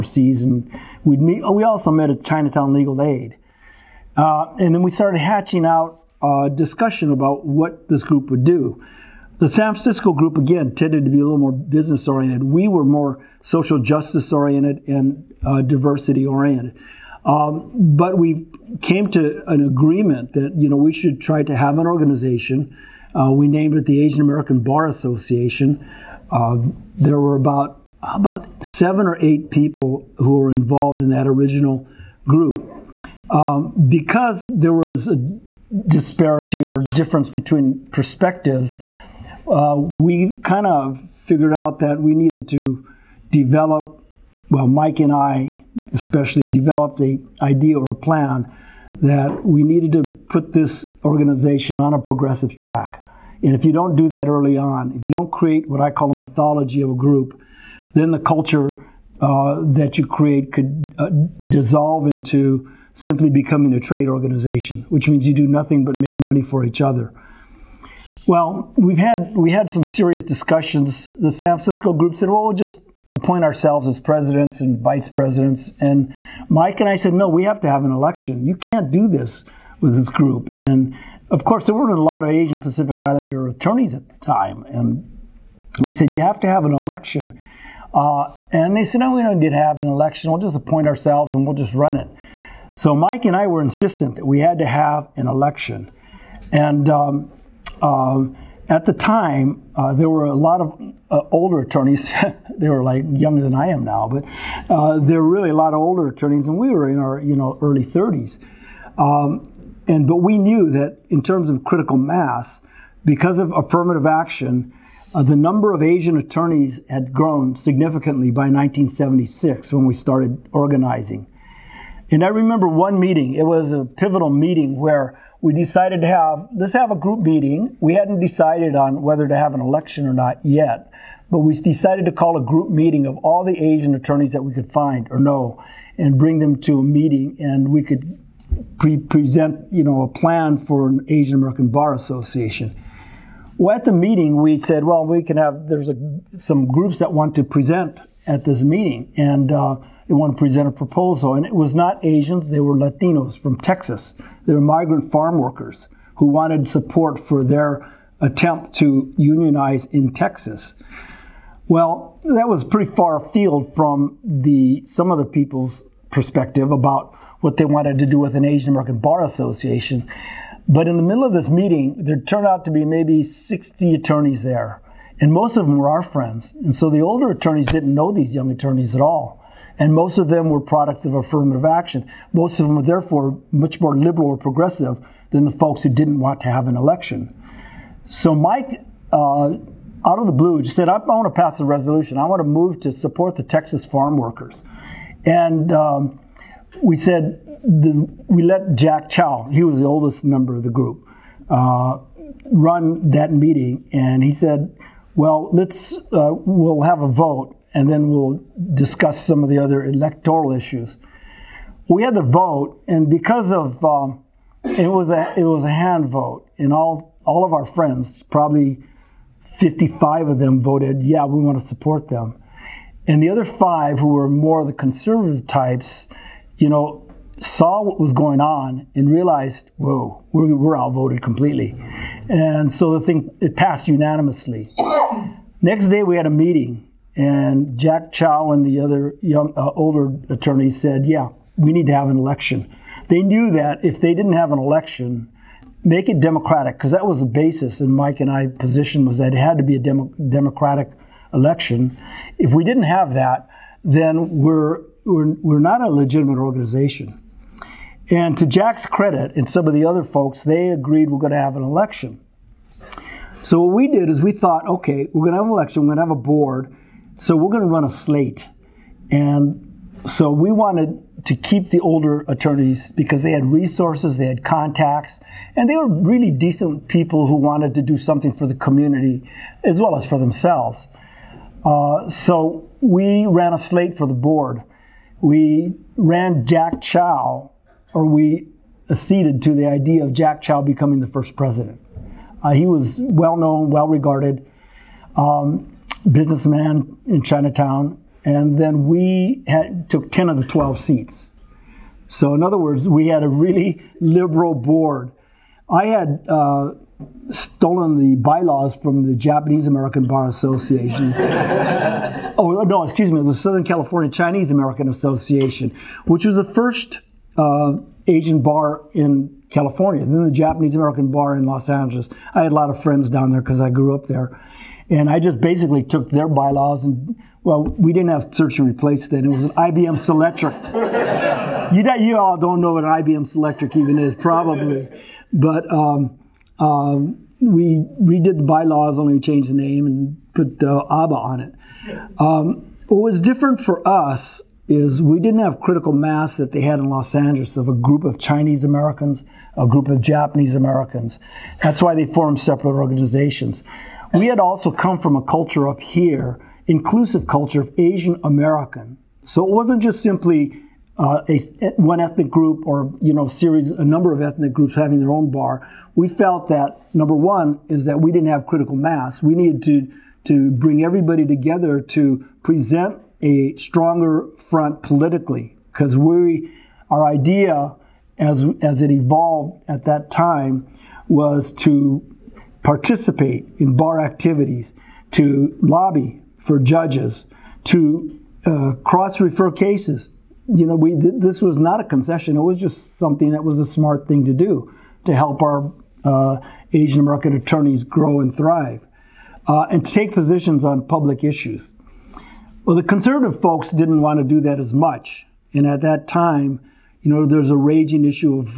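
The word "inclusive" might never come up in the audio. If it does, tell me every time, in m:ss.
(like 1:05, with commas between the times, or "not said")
5:56.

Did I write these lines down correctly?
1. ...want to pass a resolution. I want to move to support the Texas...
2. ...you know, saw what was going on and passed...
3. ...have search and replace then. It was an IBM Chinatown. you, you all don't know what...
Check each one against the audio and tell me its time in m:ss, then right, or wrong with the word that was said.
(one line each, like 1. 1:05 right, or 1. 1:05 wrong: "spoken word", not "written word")
1. 3:10 right
2. 3:46 wrong: "realized", not "passed"
3. 5:28 wrong: "Selectric", not "Chinatown".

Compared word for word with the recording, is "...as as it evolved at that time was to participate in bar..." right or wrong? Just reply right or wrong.
right.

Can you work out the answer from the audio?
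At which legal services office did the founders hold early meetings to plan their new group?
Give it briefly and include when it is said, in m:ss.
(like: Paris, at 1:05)
Chinatown Legal Aid, at 0:02.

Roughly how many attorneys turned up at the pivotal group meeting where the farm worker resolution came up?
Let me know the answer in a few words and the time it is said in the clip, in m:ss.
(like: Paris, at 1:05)
60, at 2:53.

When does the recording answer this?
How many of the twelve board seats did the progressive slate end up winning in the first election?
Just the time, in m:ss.
5:00.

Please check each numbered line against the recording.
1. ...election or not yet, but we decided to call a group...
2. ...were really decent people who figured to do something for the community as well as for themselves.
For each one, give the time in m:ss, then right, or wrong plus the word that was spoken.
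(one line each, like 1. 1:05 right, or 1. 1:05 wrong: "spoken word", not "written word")
1. 2:09 right
2. 4:35 wrong: "wanted", not "figured".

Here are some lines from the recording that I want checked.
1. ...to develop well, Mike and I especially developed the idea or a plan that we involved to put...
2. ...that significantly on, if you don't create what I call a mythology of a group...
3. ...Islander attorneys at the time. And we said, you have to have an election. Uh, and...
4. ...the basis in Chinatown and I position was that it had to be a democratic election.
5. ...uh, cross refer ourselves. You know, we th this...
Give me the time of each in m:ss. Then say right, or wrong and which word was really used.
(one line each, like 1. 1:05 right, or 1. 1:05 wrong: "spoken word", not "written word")
1. 0:42 wrong: "needed", not "involved"
2. 0:54 wrong: "early", not "significantly"
3. 1:22 right
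4. 4:07 wrong: "Mike", not "Chinatown"
5. 6:28 wrong: "cases", not "ourselves".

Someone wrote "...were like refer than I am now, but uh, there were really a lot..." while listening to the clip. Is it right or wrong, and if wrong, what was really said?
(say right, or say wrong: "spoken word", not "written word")
wrong: "younger", not "refer".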